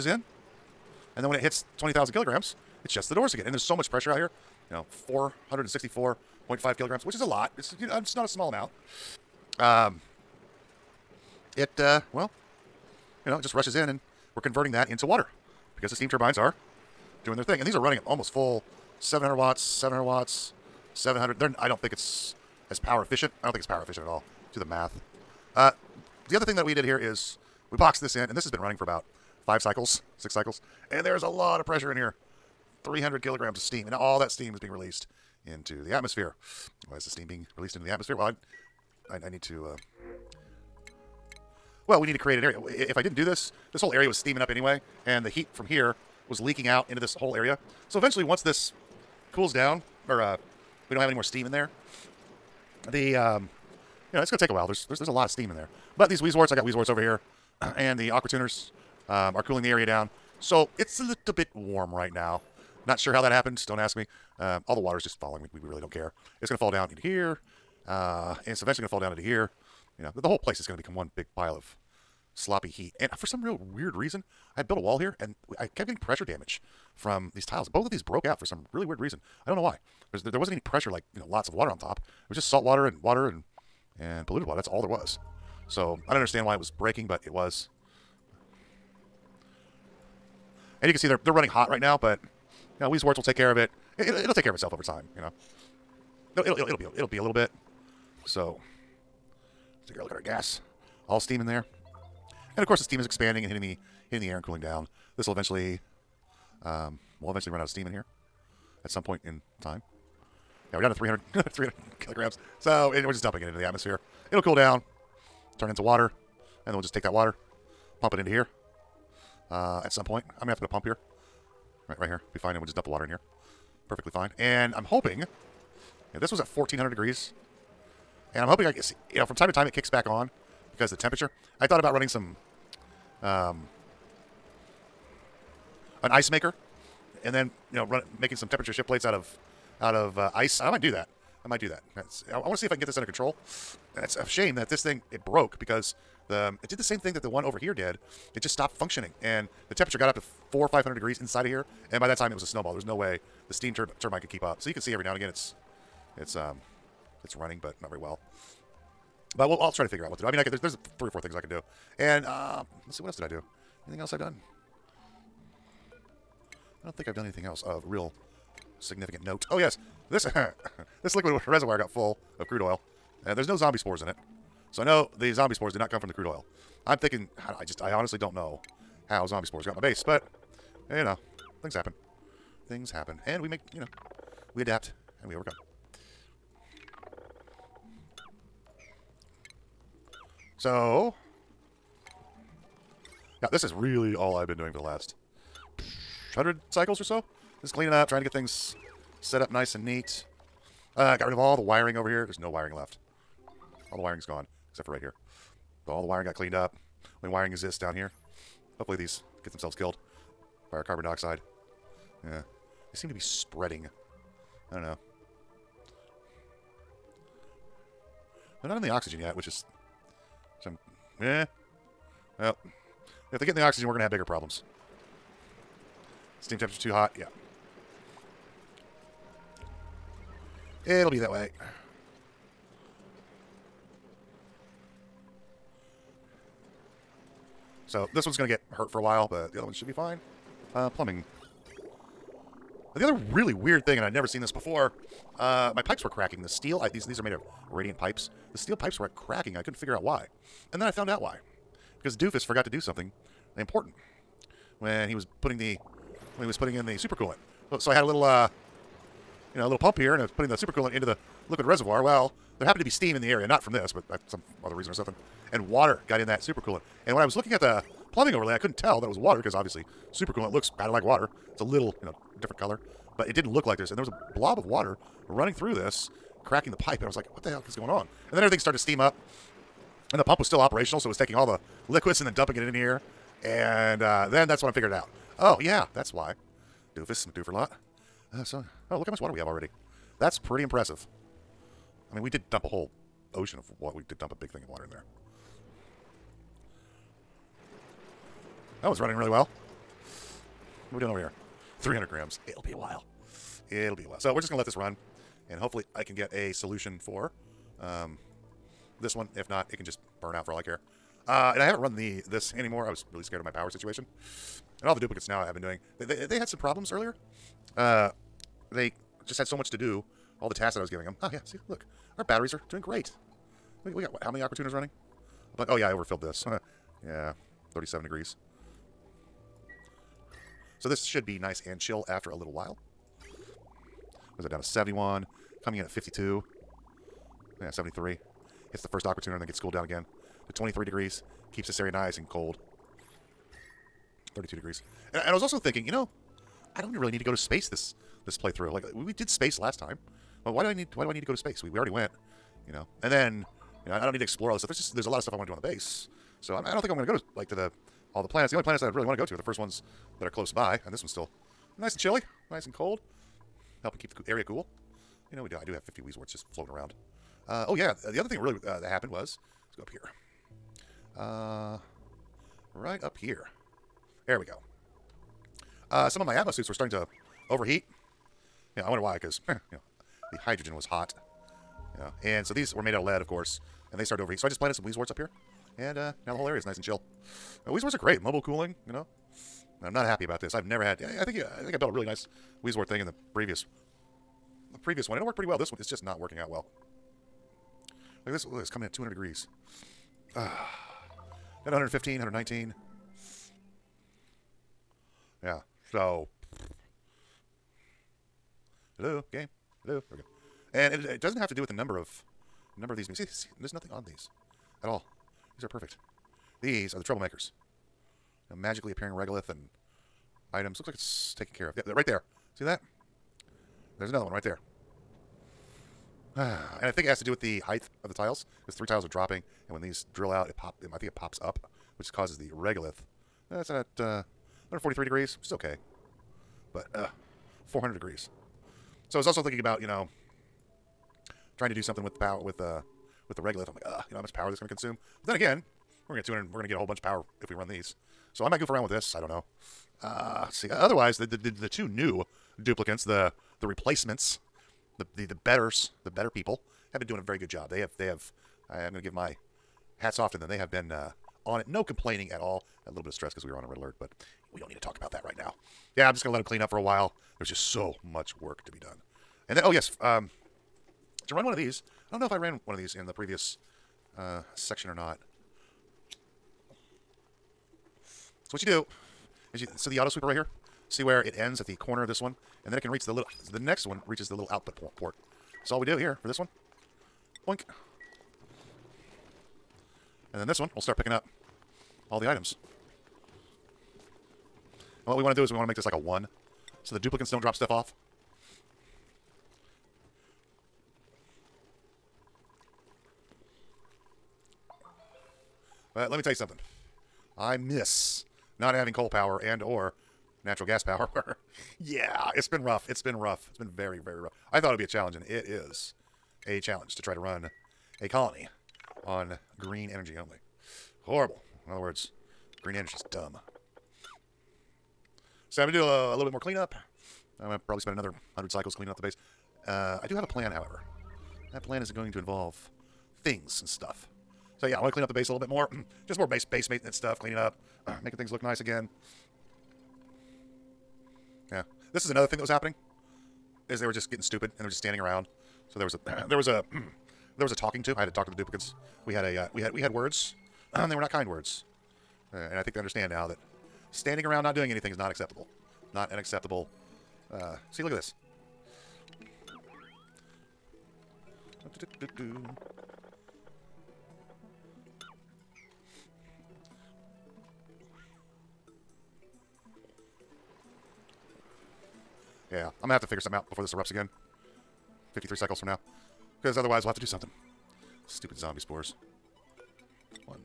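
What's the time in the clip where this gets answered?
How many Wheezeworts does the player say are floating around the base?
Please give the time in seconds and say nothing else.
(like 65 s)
365 s.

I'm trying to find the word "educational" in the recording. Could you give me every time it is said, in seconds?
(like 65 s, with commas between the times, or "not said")
not said.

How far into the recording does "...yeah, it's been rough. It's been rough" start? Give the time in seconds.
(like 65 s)
511 s.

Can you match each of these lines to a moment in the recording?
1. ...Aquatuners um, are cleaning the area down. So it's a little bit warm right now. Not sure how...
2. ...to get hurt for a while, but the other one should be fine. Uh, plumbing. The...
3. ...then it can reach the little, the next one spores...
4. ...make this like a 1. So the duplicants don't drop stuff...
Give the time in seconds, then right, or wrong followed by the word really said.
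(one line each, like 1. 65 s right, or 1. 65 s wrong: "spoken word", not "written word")
1. 58 s wrong: "cooling", not "cleaning"
2. 238 s right
3. 482 s wrong: "reaches", not "spores"
4. 495 s right.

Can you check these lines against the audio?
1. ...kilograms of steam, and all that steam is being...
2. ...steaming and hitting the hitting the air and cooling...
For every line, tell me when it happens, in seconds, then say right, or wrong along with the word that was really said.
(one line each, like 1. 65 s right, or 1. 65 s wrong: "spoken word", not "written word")
1. 33 s right
2. 103 s wrong: "expanding", not "steaming".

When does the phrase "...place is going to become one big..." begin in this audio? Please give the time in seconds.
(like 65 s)
70 s.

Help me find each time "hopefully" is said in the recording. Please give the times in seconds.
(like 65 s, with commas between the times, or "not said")
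208 s, 305 s.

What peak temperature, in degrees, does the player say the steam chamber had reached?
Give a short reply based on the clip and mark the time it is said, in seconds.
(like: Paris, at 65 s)
1,400 degrees, at 126 s.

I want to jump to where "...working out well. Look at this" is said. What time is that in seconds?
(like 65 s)
396 s.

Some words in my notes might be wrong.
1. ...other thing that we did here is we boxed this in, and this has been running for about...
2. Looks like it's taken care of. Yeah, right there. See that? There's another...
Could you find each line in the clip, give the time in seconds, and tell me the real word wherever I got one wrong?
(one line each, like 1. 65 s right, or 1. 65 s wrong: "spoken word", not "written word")
1. 26 s right
2. 420 s right.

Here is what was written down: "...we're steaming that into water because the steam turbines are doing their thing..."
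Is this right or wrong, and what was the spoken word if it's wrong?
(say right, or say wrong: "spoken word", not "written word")
wrong: "converting", not "steaming".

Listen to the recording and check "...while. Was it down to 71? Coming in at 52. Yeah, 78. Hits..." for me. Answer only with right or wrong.
wrong.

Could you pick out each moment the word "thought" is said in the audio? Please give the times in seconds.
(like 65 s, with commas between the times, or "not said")
131 s, 514 s.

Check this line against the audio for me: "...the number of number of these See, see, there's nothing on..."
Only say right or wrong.
right.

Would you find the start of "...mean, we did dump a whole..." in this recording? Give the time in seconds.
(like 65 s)
292 s.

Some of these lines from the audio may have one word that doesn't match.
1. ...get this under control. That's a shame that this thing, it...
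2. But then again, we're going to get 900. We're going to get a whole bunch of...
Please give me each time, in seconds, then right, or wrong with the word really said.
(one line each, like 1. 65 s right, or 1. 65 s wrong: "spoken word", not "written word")
1. 142 s right
2. 445 s wrong: "200", not "900".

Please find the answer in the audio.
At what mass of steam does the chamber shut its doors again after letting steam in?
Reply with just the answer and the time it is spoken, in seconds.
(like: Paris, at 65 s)
20,000 kilograms, at 1 s.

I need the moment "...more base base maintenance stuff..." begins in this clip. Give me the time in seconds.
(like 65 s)
536 s.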